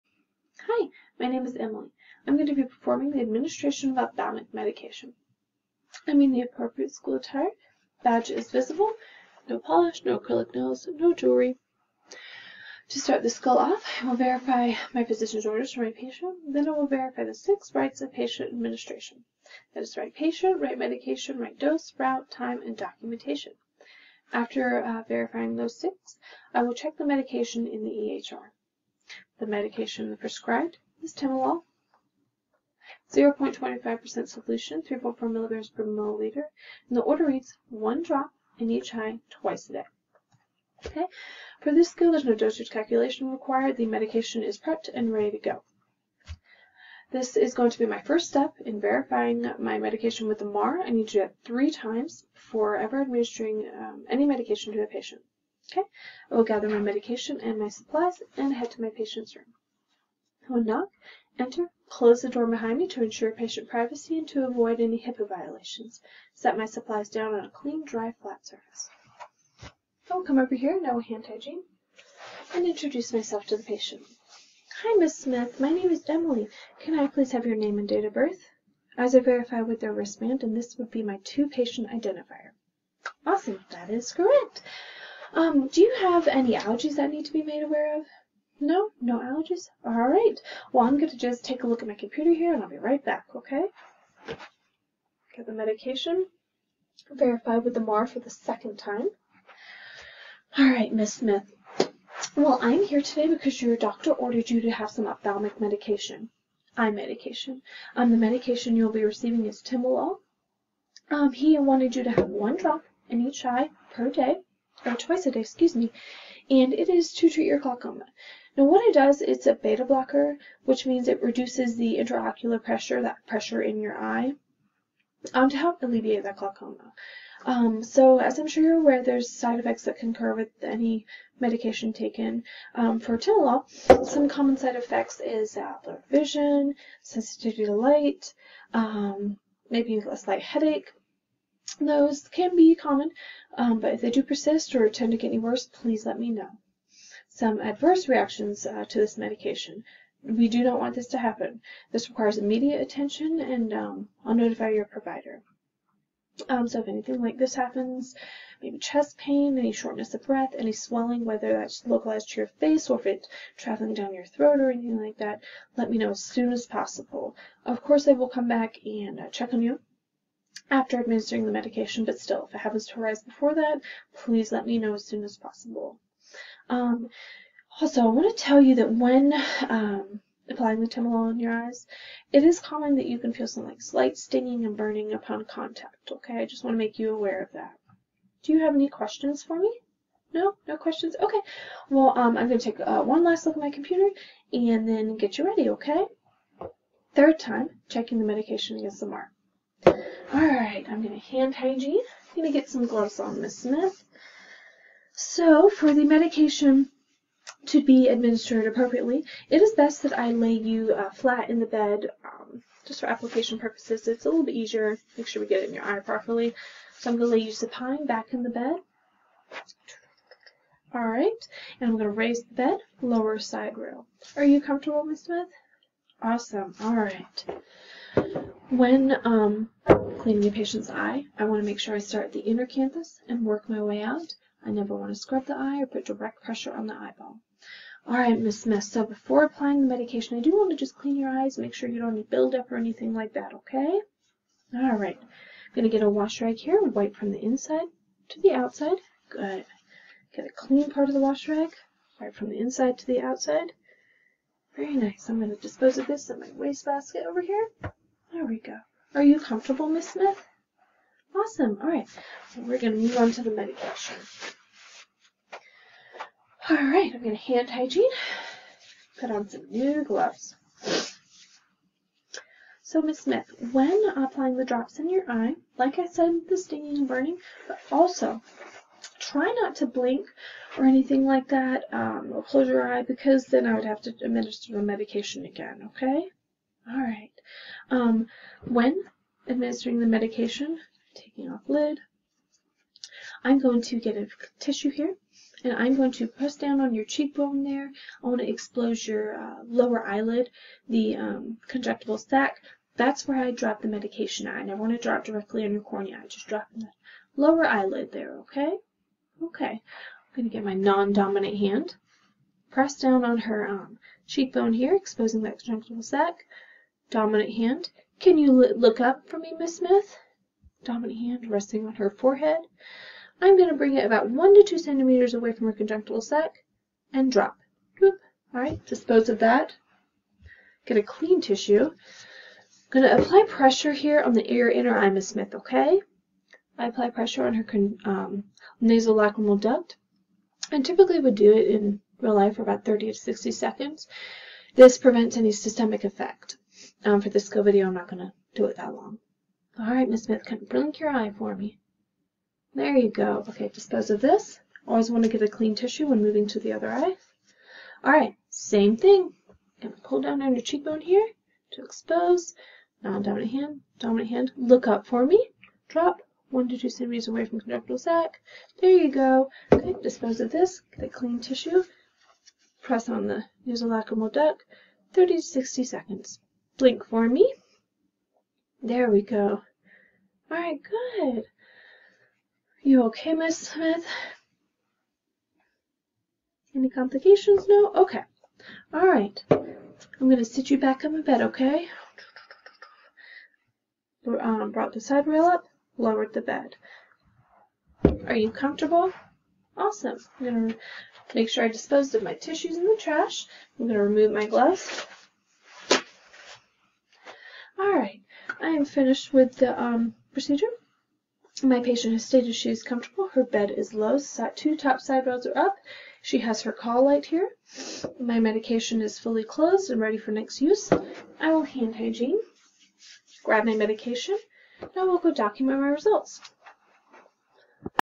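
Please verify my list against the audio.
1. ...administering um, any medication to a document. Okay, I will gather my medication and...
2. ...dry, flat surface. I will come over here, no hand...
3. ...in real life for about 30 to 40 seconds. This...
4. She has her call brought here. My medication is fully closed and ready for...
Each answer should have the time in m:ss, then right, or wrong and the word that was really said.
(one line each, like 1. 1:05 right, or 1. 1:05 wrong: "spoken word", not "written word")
1. 0:53 wrong: "patient", not "document"
2. 1:07 right
3. 5:41 wrong: "60", not "40"
4. 6:56 wrong: "light", not "brought".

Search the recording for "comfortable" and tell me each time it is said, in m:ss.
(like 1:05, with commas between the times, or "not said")
3:44, 4:19, 6:38, 6:52.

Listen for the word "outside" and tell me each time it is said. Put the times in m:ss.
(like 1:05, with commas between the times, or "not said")
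4:08, 4:13.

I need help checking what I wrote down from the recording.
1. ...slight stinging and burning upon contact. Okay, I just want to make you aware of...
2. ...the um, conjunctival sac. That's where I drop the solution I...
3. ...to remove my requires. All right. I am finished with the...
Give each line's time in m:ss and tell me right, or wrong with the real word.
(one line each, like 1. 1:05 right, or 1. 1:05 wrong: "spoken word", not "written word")
1. 3:03 right
2. 5:00 wrong: "medication", not "solution"
3. 6:43 wrong: "gloves", not "requires".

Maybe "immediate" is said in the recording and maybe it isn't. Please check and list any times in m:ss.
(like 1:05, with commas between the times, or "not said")
2:32.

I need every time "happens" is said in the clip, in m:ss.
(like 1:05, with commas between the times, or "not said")
2:31, 2:37, 2:52.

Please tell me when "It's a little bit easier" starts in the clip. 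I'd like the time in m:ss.
3:34.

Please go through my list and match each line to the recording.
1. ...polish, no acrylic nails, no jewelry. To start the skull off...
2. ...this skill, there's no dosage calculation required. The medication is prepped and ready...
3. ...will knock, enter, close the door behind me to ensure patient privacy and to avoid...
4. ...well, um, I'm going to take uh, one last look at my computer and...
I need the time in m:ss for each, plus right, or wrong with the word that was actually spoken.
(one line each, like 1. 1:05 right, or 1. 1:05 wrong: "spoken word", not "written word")
1. 0:09 right
2. 0:41 right
3. 1:00 right
4. 3:11 right.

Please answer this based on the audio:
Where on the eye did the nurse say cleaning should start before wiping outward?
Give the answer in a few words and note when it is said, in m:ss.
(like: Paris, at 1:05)
inner canthus, at 3:52.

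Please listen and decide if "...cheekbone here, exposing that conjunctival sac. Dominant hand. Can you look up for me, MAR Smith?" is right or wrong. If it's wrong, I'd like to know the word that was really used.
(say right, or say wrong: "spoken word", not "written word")
wrong: "Miss", not "MAR".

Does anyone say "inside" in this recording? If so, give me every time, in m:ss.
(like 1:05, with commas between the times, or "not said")
4:07, 4:12.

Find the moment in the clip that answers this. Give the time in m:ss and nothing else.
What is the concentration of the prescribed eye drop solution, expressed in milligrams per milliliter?
0:34.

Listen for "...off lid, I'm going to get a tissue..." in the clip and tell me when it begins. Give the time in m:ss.
4:51.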